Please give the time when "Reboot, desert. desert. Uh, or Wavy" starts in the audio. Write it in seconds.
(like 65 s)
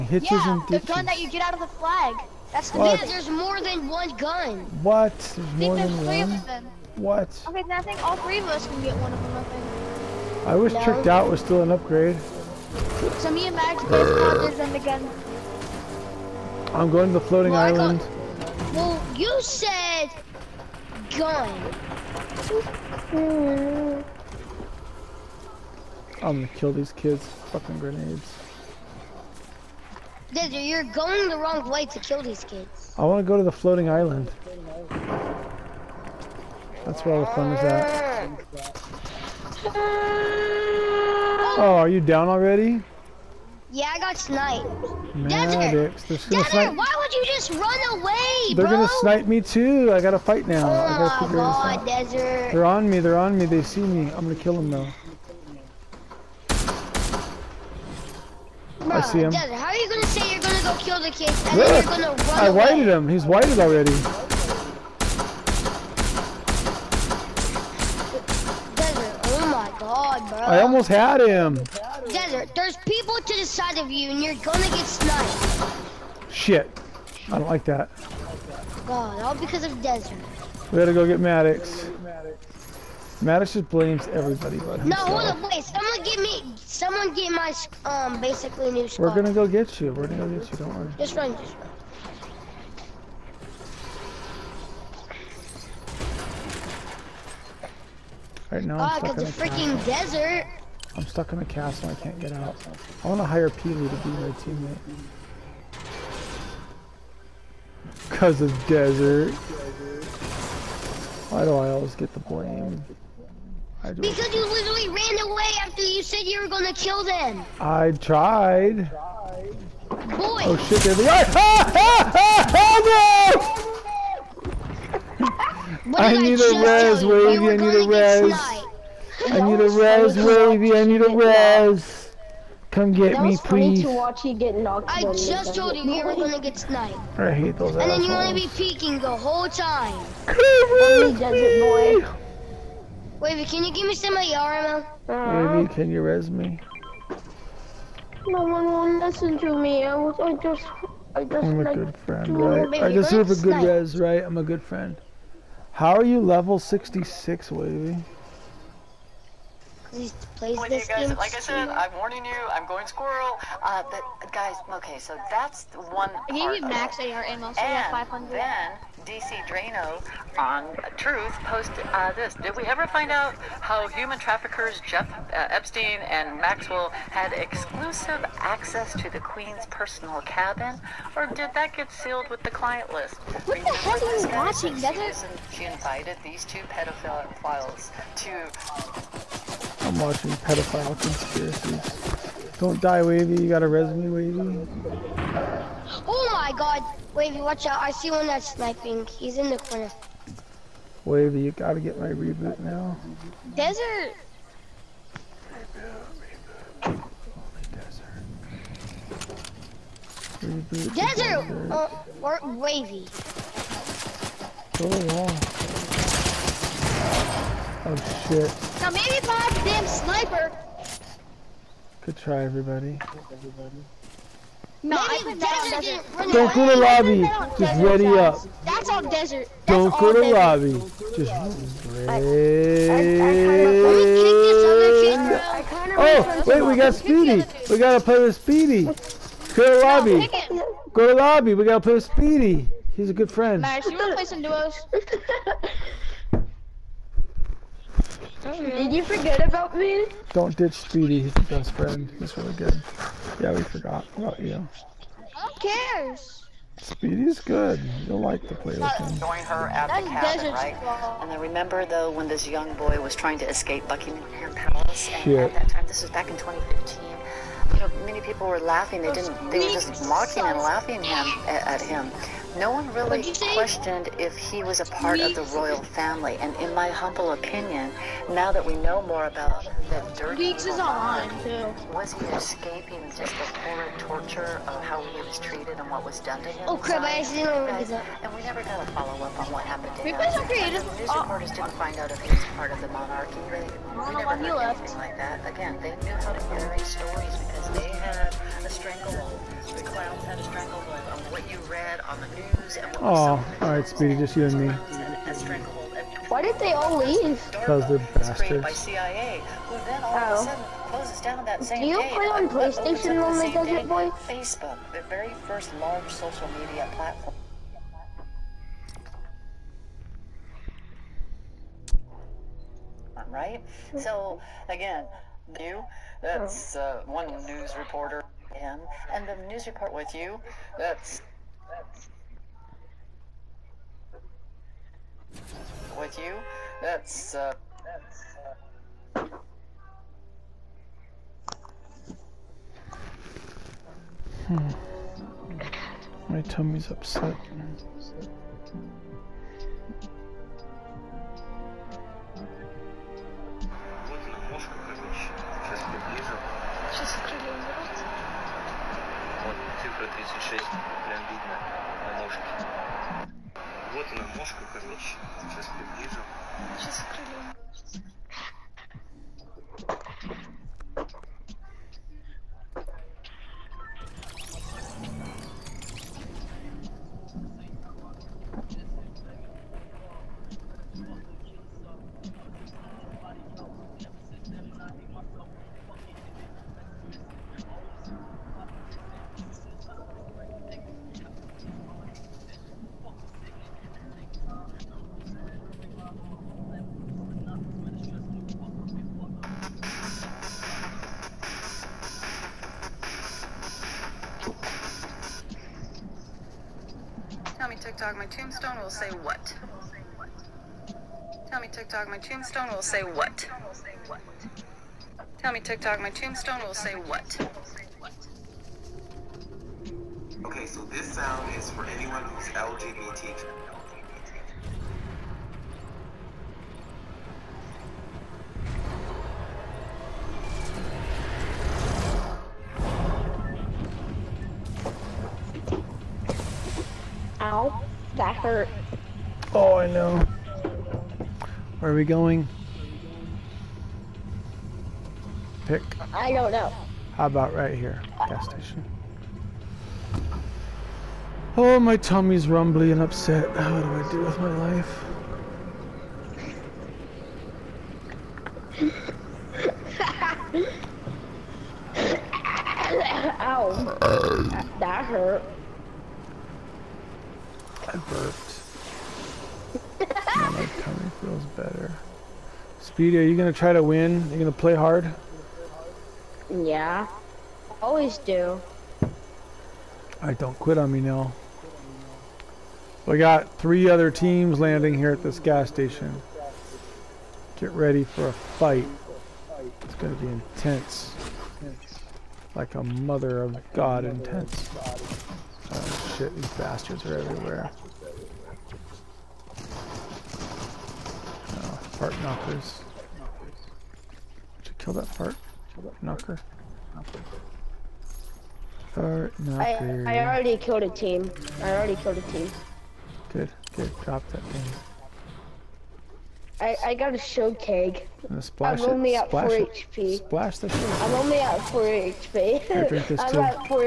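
210 s.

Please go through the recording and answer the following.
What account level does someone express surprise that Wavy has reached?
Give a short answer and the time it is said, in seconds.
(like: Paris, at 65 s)
66, at 156 s.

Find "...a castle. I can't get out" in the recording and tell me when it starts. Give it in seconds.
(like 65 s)
101 s.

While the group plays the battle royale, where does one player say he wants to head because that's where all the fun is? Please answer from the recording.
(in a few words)
floating island.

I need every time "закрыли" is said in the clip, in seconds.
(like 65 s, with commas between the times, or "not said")
366 s.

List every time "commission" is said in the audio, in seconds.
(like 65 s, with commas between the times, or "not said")
not said.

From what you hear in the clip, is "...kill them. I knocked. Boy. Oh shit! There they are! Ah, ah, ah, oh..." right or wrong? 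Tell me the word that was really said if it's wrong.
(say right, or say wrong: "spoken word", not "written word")
wrong: "tried", not "knocked".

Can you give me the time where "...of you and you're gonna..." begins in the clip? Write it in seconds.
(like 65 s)
73 s.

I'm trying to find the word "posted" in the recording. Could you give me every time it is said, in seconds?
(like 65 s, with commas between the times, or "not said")
171 s.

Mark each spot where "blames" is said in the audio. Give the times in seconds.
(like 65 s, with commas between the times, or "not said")
83 s, 112 s.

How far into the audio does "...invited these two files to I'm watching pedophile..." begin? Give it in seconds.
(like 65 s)
185 s.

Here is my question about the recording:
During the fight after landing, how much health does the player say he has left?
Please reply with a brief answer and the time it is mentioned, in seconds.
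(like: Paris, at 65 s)
4 HP, at 521 s.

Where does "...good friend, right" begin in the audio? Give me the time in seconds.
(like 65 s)
151 s.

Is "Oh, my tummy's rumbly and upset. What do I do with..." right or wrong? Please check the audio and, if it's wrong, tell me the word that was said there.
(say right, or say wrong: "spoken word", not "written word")
right.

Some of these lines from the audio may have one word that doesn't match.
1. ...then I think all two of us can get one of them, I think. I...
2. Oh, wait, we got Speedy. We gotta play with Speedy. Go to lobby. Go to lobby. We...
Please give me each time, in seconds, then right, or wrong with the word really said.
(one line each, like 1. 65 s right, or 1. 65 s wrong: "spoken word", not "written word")
1. 7 s wrong: "three", not "two"
2. 236 s right.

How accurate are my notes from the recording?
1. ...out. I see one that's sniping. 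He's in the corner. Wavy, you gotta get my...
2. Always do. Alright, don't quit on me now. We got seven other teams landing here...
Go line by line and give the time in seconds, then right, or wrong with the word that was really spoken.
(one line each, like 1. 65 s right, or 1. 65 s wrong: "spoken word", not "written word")
1. 197 s right
2. 477 s wrong: "three", not "seven".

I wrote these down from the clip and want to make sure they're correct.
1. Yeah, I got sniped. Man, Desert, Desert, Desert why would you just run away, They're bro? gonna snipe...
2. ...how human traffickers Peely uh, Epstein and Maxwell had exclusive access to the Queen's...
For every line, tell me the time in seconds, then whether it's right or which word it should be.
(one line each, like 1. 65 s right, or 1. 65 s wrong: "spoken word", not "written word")
1. 43 s right
2. 173 s wrong: "Jeff", not "Peely".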